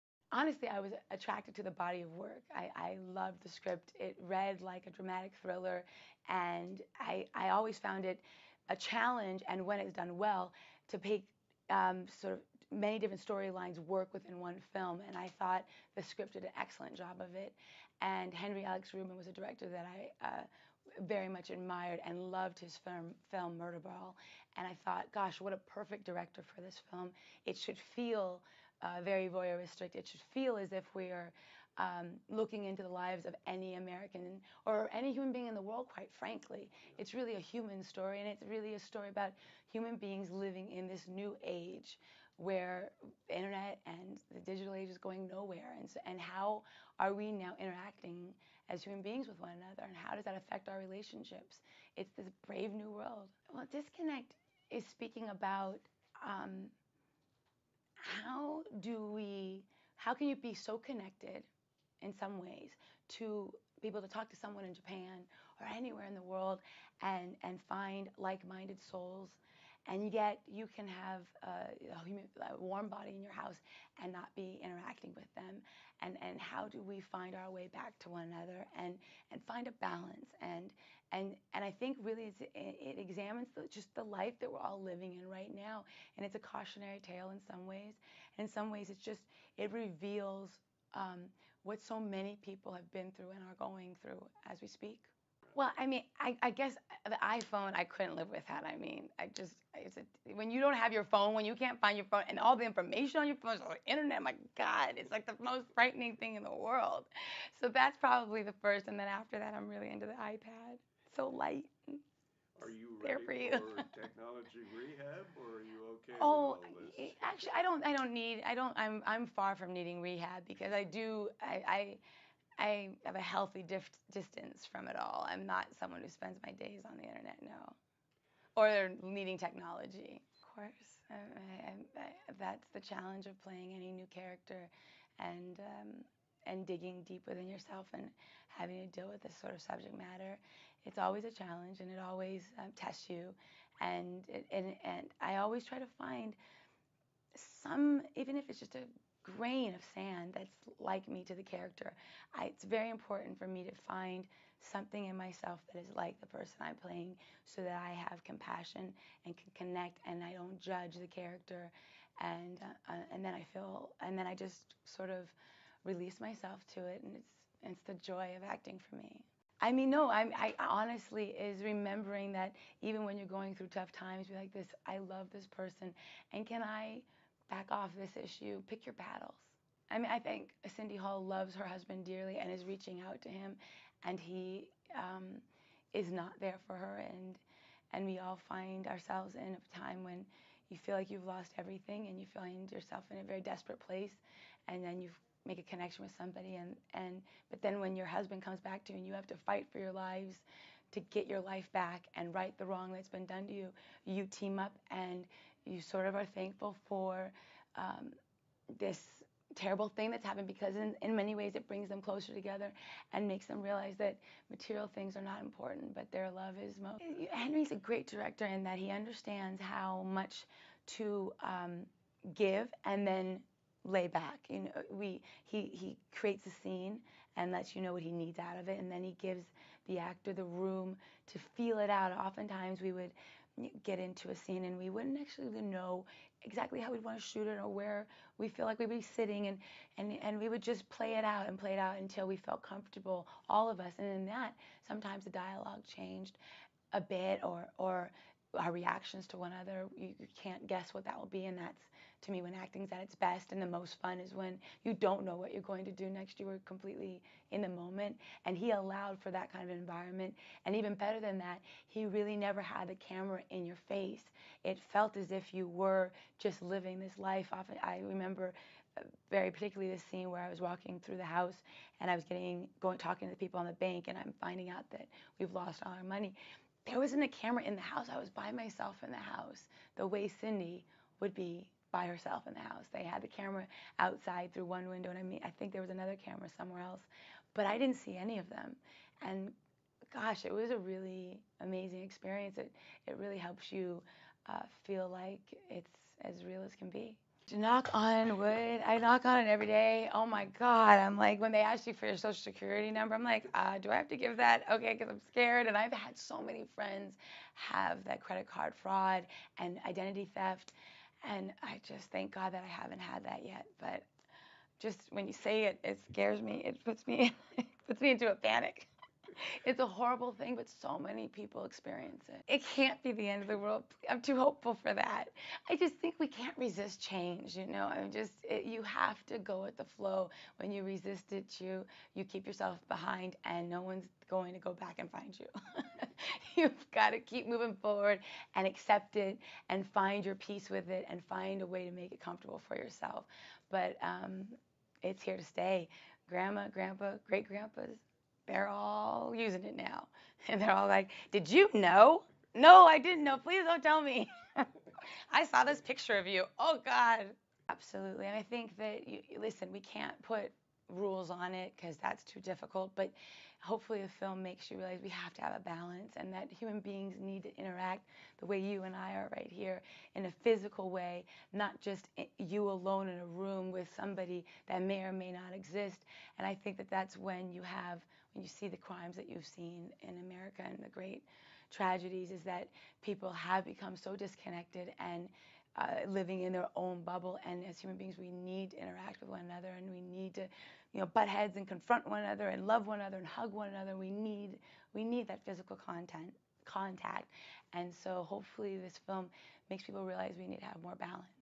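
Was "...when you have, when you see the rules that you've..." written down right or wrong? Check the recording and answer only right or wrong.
wrong.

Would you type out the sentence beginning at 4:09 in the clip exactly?
You, you, can't guess what that will be.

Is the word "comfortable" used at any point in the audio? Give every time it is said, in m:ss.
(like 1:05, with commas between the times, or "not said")
4:02, 5:42.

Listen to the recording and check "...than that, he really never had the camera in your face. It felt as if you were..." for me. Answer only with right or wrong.
right.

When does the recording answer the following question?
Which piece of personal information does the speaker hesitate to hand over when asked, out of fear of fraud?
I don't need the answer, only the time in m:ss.
5:02.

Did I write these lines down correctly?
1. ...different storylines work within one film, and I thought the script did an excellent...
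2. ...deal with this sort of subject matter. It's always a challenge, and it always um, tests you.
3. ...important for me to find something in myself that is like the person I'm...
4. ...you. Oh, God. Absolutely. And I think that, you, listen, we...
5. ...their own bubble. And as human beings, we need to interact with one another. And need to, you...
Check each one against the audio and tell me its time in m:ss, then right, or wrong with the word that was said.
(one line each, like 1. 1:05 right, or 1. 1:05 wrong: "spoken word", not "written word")
1. 0:12 right
2. 2:18 right
3. 2:32 right
4. 5:56 right
5. 6:26 right.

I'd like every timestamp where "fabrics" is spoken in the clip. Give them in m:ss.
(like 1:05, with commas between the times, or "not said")
not said.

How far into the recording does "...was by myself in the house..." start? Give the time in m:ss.
4:38.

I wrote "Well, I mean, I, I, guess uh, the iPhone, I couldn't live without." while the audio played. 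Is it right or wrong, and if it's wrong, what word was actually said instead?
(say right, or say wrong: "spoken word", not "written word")
right.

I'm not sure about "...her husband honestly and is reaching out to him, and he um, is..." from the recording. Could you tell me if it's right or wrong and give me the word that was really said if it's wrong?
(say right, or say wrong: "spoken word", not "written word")
wrong: "dearly", not "honestly".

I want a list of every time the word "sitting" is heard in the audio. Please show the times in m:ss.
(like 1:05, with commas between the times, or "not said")
3:59.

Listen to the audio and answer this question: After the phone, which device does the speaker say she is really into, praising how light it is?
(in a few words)
iPad.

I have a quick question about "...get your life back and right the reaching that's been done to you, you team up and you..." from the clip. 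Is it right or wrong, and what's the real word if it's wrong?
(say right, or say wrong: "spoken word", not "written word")
wrong: "wrong", not "reaching".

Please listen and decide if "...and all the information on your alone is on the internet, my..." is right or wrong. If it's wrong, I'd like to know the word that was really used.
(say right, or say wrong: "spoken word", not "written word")
wrong: "phone", not "alone".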